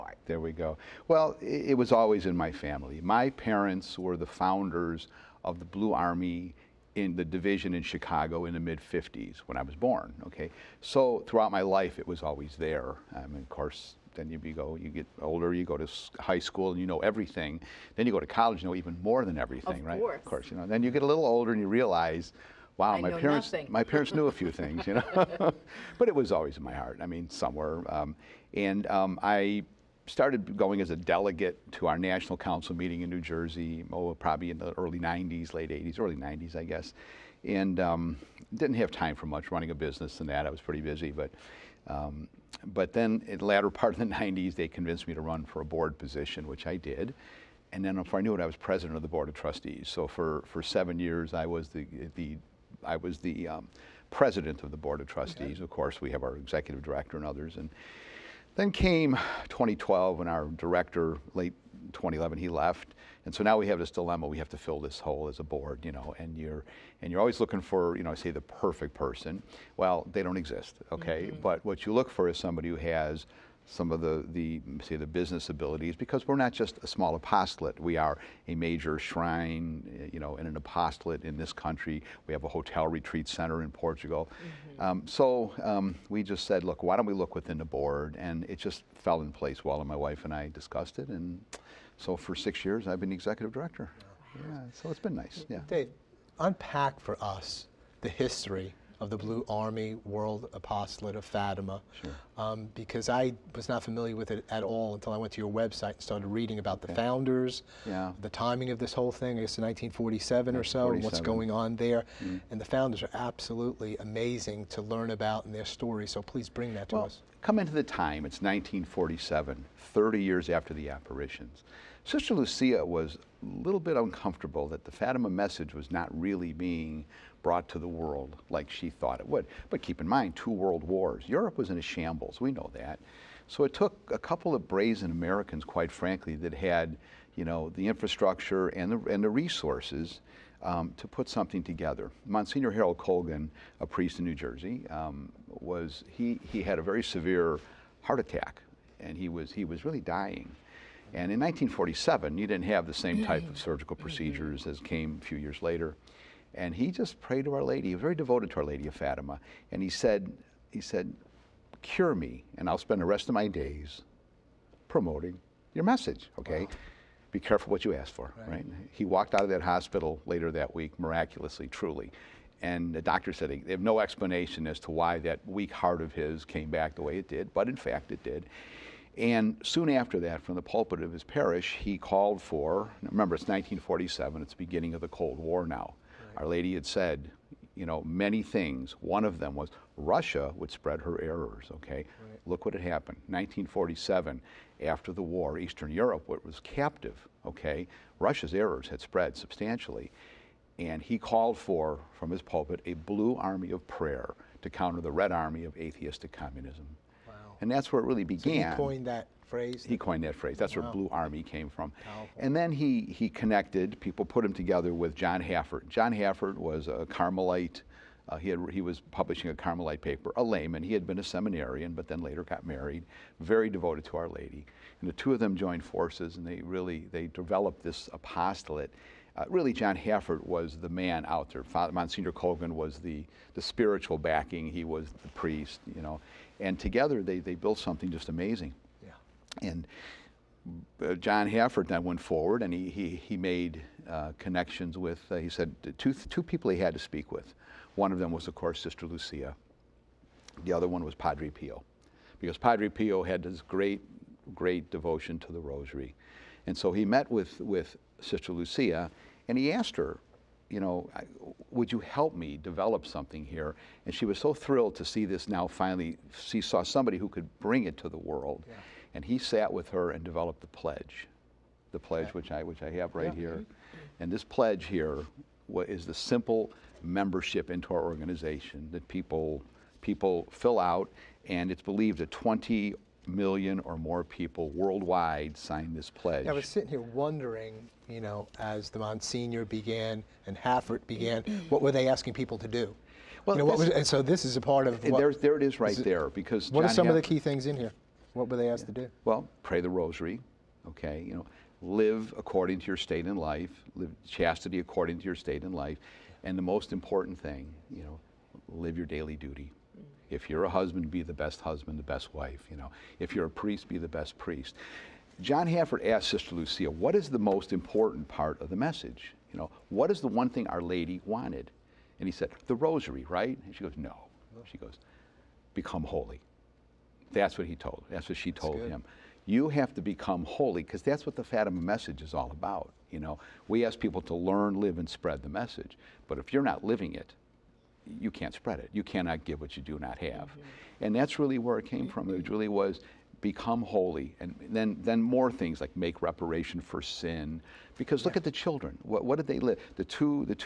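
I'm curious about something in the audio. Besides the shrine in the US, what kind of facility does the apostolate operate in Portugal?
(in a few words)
hotel retreat center.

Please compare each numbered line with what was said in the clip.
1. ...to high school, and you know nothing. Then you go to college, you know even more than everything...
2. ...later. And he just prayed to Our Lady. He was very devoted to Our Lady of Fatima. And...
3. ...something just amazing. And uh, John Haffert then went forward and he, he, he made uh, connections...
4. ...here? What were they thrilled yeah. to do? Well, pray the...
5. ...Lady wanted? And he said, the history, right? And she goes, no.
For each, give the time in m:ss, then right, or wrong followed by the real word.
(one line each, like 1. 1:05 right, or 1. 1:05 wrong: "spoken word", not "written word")
1. 0:15 wrong: "everything", not "nothing"
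2. 2:35 right
3. 3:57 right
4. 4:57 wrong: "asked", not "thrilled"
5. 5:20 wrong: "rosary", not "history".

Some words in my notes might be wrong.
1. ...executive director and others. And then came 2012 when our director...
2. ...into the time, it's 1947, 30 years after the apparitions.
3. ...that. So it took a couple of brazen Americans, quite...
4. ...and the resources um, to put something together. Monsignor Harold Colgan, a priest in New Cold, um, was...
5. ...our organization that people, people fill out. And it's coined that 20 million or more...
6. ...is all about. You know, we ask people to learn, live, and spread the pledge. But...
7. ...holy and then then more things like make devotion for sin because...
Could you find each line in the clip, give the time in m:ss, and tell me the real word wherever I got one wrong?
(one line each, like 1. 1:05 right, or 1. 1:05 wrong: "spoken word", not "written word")
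1. 0:56 right
2. 1:57 right
3. 2:12 right
4. 2:19 wrong: "Jersey", not "Cold"
5. 4:37 wrong: "believed", not "coined"
6. 5:32 wrong: "message", not "pledge"
7. 5:43 wrong: "reparation", not "devotion".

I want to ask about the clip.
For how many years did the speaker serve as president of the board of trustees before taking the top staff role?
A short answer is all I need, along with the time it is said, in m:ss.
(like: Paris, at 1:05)
7, at 0:50.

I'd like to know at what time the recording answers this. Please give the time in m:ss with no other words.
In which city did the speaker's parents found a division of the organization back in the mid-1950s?
0:07.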